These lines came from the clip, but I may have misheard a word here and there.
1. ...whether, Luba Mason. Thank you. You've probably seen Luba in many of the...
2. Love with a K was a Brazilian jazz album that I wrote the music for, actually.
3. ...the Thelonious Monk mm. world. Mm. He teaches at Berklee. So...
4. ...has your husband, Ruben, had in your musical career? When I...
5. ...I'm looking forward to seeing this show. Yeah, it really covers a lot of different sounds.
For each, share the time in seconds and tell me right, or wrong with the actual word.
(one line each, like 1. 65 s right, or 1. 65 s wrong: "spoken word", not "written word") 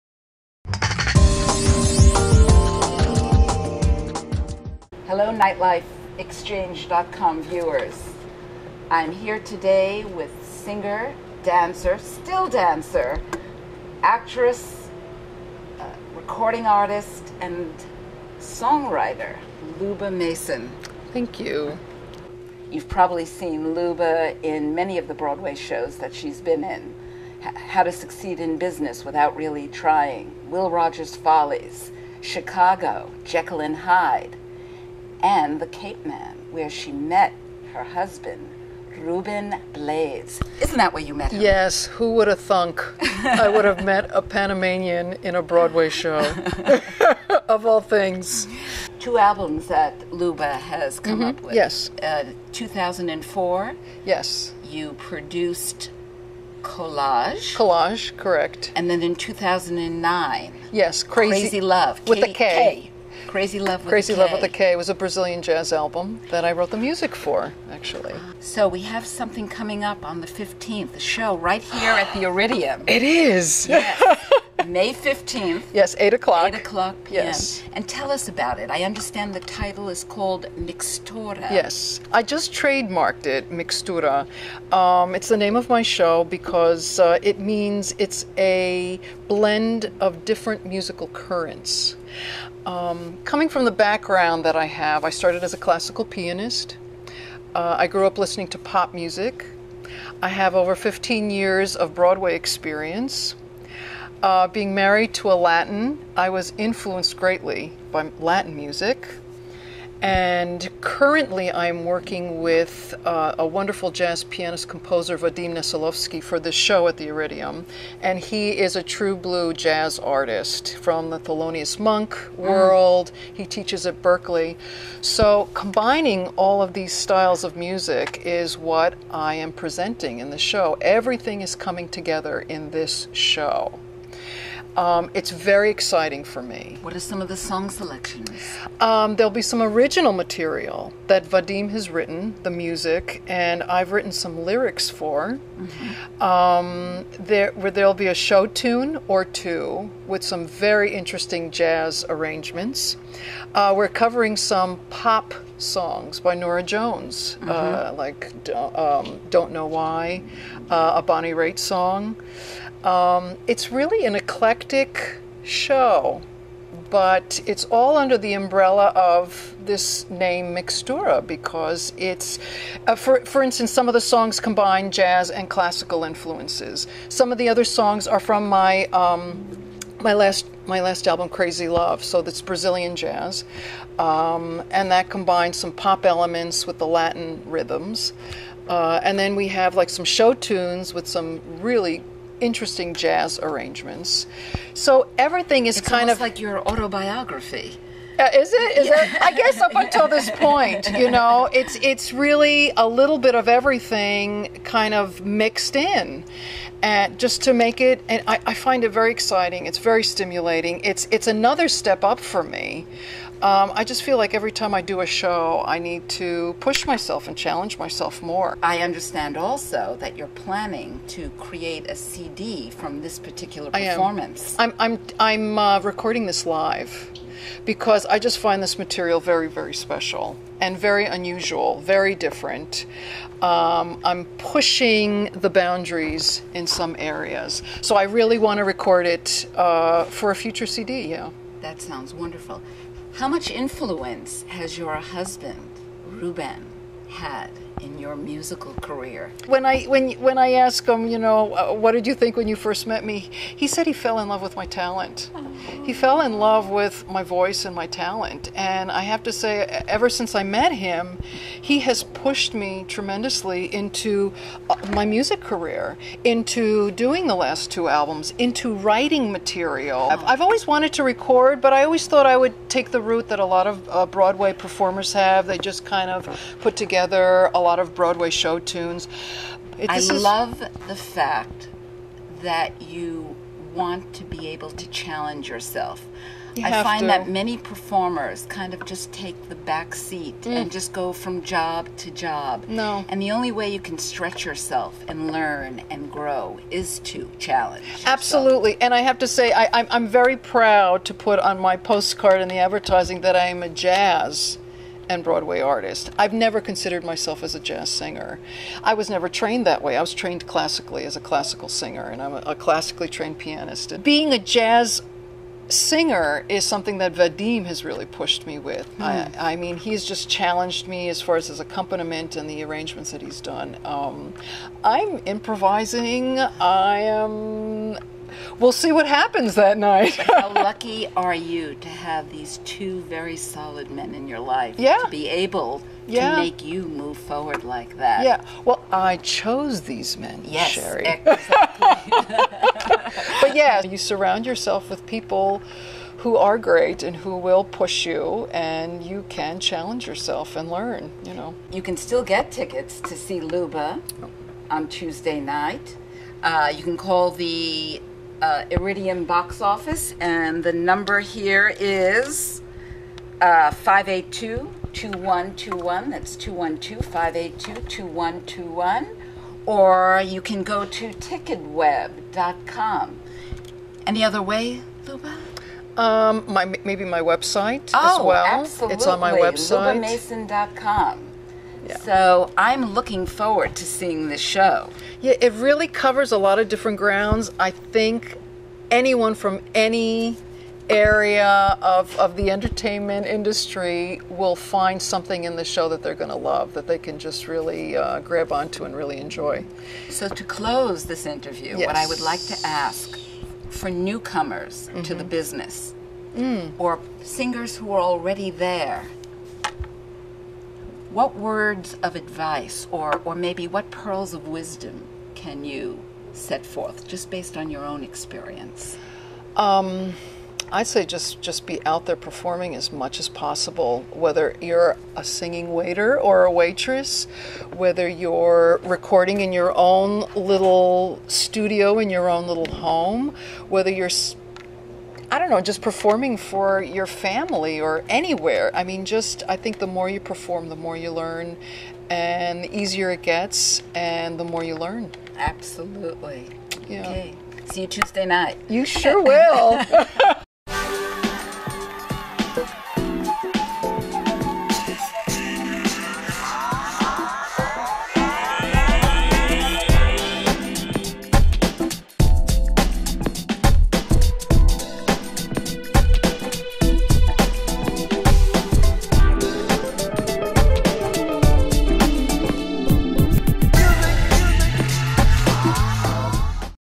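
1. 18 s wrong: "songwriter", not "whether"
2. 64 s right
3. 121 s right
4. 244 s right
5. 382 s wrong: "grounds", not "sounds".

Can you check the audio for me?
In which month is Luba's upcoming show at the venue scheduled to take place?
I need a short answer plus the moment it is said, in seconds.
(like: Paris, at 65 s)
May, at 74 s.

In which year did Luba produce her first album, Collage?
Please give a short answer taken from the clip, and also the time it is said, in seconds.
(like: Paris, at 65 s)
2004, at 52 s.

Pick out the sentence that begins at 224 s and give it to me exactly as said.
I'm, I'm, I'm uh, recording this live because I just find this material very, very special and very unusual, very different.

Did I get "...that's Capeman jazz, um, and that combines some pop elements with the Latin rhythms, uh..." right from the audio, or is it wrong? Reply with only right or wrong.
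wrong.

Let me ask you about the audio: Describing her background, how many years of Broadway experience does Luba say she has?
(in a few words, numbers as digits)
15 years.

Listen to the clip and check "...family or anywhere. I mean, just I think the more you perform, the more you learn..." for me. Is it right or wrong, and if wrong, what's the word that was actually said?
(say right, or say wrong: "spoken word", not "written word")
right.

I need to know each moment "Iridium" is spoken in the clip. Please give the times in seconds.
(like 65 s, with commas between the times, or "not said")
72 s, 117 s, 358 s.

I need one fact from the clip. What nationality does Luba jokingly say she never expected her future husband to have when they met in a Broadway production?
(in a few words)
Panamanian.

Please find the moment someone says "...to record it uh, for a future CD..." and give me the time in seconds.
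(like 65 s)
238 s.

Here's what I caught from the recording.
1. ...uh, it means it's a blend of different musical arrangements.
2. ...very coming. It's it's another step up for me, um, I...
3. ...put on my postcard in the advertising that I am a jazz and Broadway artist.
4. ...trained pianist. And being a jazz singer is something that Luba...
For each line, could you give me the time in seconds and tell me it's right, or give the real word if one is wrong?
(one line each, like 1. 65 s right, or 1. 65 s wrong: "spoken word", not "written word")
1. 87 s wrong: "currents", not "arrangements"
2. 209 s wrong: "stimulating", not "coming"
3. 301 s right
4. 313 s wrong: "Vadim", not "Luba".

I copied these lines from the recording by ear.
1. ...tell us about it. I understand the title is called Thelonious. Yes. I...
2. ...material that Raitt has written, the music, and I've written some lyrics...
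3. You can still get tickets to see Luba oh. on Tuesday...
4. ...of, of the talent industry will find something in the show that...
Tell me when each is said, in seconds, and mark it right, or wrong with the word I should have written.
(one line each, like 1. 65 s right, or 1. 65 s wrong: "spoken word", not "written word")
1. 77 s wrong: "Mixtura", not "Thelonious"
2. 140 s wrong: "Vadim", not "Raitt"
3. 351 s right
4. 391 s wrong: "entertainment", not "talent".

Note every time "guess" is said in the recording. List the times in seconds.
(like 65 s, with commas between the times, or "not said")
199 s.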